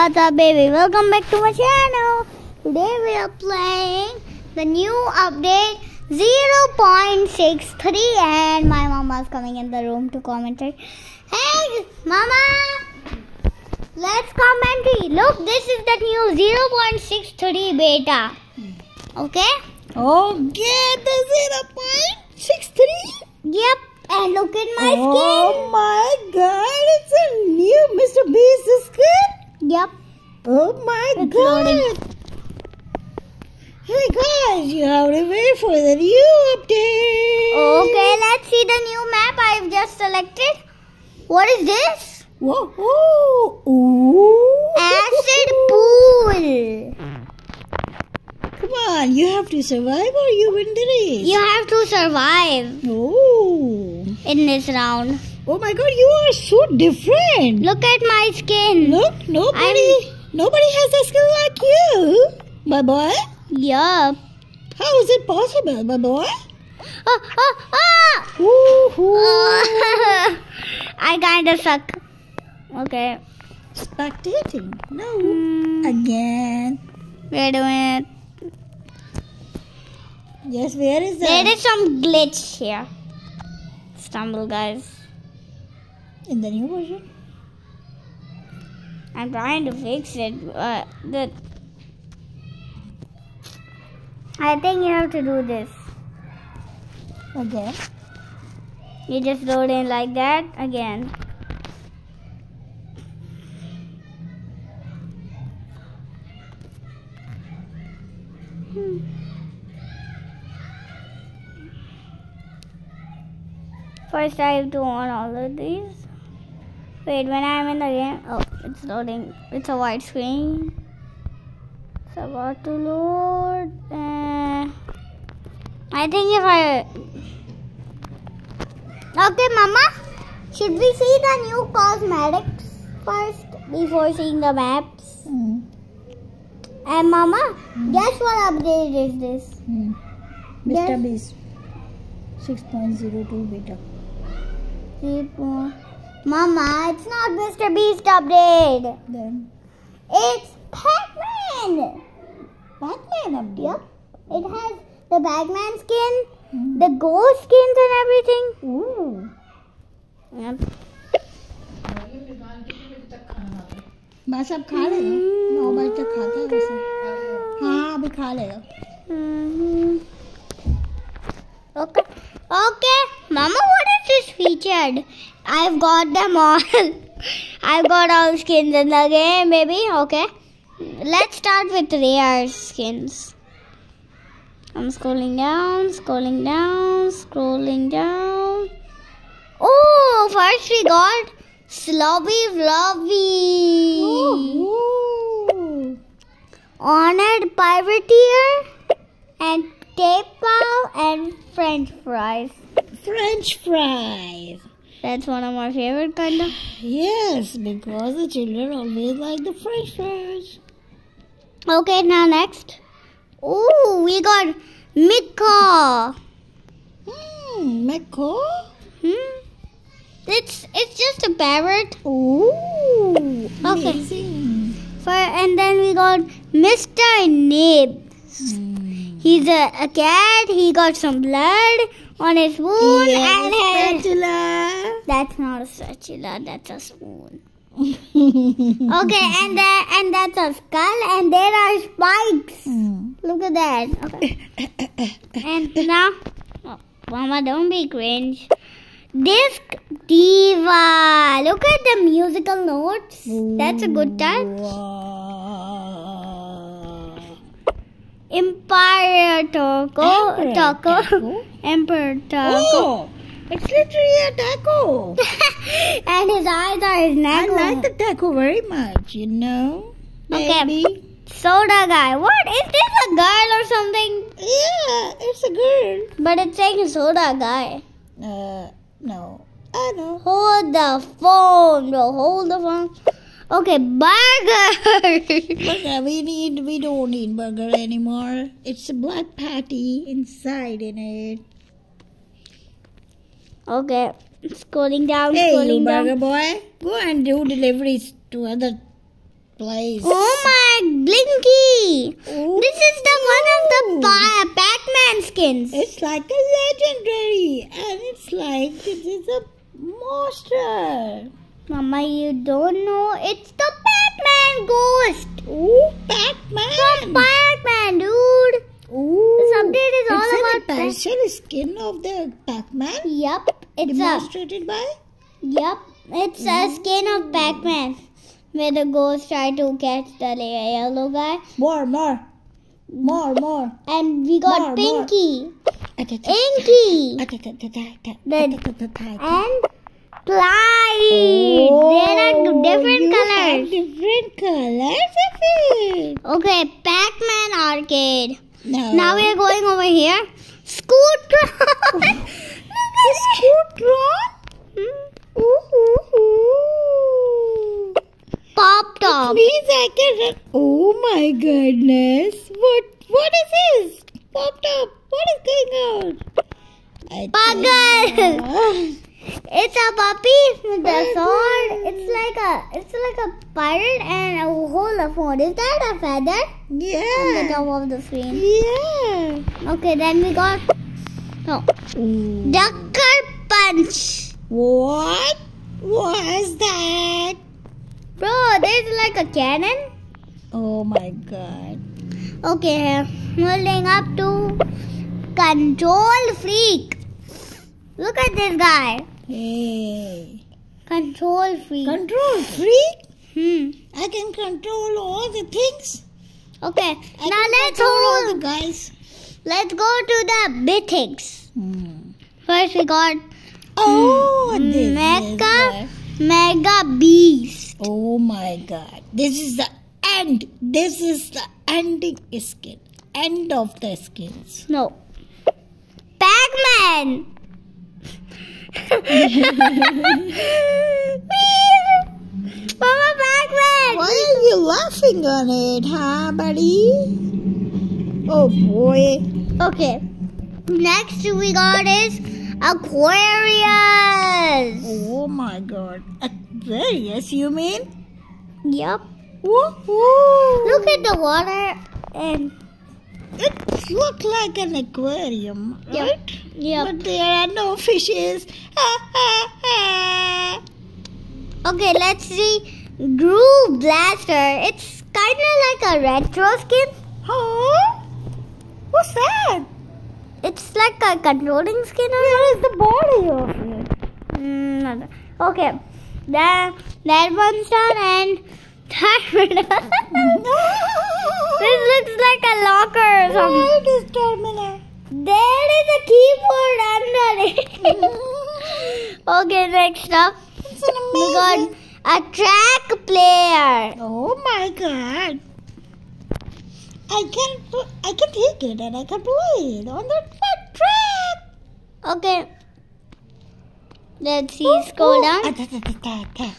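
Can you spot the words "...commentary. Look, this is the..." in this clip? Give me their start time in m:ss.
0:14.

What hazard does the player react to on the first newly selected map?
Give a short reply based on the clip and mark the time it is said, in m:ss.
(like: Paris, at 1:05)
Acid pool, at 0:44.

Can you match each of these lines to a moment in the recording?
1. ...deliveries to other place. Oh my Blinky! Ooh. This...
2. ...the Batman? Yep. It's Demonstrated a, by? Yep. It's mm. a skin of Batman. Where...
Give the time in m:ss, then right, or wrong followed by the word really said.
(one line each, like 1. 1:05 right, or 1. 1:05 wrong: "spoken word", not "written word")
1. 4:57 right
2. 5:22 right.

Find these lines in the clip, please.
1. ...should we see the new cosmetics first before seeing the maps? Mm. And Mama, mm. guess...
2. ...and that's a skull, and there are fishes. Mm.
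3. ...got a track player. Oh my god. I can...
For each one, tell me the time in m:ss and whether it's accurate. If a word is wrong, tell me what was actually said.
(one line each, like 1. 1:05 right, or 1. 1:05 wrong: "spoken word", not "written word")
1. 2:10 right
2. 3:59 wrong: "spikes", not "fishes"
3. 8:11 right.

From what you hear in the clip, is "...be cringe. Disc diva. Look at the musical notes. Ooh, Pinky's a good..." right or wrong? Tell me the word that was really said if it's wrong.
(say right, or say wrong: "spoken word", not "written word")
wrong: "That", not "Pinky".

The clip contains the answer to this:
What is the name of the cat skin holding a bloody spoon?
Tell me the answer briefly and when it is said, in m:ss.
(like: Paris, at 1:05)
Mr. Nib, at 3:46.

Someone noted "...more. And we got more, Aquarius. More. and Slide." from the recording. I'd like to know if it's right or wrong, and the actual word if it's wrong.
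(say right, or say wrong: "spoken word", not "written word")
wrong: "Pinky", not "Aquarius".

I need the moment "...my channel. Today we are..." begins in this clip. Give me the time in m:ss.
0:01.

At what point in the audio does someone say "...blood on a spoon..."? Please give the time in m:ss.
3:51.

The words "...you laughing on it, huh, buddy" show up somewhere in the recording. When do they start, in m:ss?
7:14.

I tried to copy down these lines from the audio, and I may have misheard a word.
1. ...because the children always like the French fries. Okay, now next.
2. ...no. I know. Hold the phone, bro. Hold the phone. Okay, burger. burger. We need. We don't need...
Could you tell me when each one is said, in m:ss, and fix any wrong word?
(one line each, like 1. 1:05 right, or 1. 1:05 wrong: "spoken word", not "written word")
1. 3:27 right
2. 4:38 right.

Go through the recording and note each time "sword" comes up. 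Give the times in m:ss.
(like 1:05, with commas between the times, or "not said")
6:11, 6:15.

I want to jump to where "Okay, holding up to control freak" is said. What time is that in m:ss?
6:32.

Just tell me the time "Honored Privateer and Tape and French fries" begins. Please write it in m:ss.
3:16.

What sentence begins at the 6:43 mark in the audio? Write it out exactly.
I can control all the things.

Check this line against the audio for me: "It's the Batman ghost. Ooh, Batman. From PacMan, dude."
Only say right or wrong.
wrong.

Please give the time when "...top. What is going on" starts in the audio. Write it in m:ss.
6:04.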